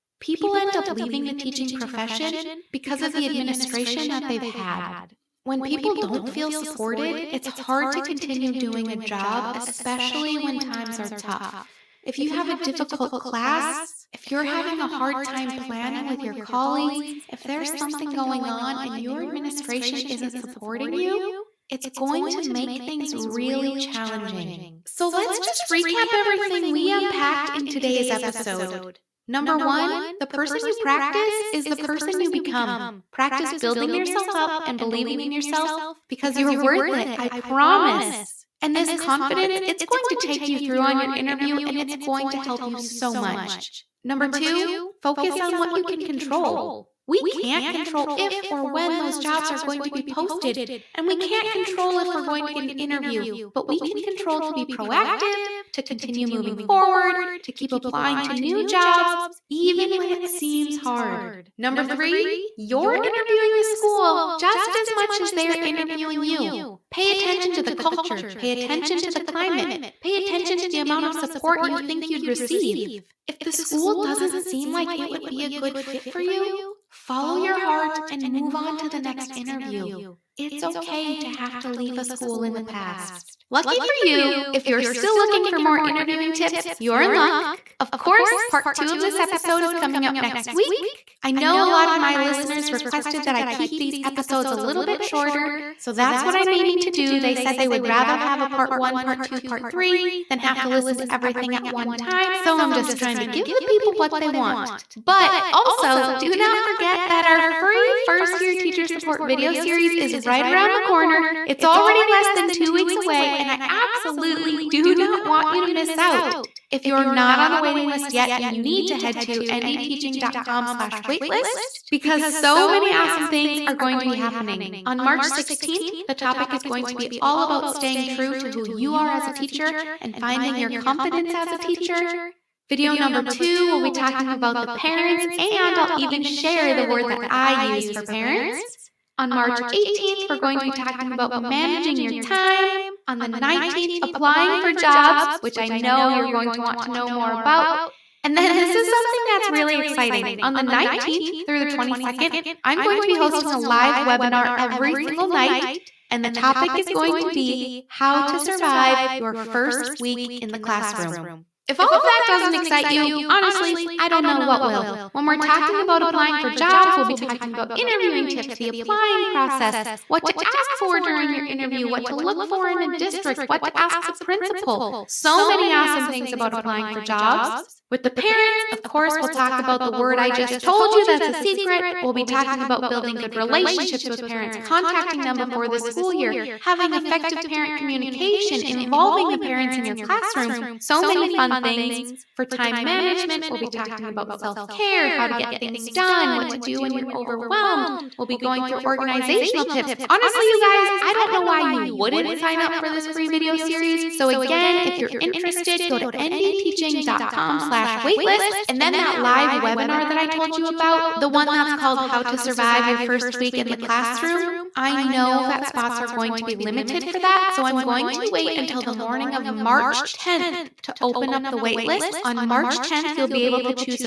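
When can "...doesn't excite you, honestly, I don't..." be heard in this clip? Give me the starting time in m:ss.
2:42.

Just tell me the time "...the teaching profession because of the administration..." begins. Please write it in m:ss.
0:01.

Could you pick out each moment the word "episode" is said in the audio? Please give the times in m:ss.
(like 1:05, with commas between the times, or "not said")
0:28, 1:29, 1:34.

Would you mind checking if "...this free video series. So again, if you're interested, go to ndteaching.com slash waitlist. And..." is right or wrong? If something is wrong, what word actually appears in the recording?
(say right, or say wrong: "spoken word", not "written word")
right.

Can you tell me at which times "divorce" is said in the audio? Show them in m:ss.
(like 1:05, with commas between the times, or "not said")
not said.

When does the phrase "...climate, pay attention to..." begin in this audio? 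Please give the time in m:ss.
1:09.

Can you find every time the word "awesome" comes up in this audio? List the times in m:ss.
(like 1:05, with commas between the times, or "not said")
2:02, 2:55.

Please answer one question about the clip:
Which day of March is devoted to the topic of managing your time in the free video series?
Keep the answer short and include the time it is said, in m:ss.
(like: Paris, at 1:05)
March 18th, at 2:19.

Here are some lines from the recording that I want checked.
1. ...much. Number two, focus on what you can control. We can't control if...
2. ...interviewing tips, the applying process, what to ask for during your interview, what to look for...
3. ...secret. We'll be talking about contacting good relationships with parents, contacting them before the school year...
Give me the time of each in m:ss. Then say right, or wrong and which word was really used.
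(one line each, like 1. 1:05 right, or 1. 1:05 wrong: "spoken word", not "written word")
1. 0:43 right
2. 2:47 right
3. 3:01 wrong: "building", not "contacting".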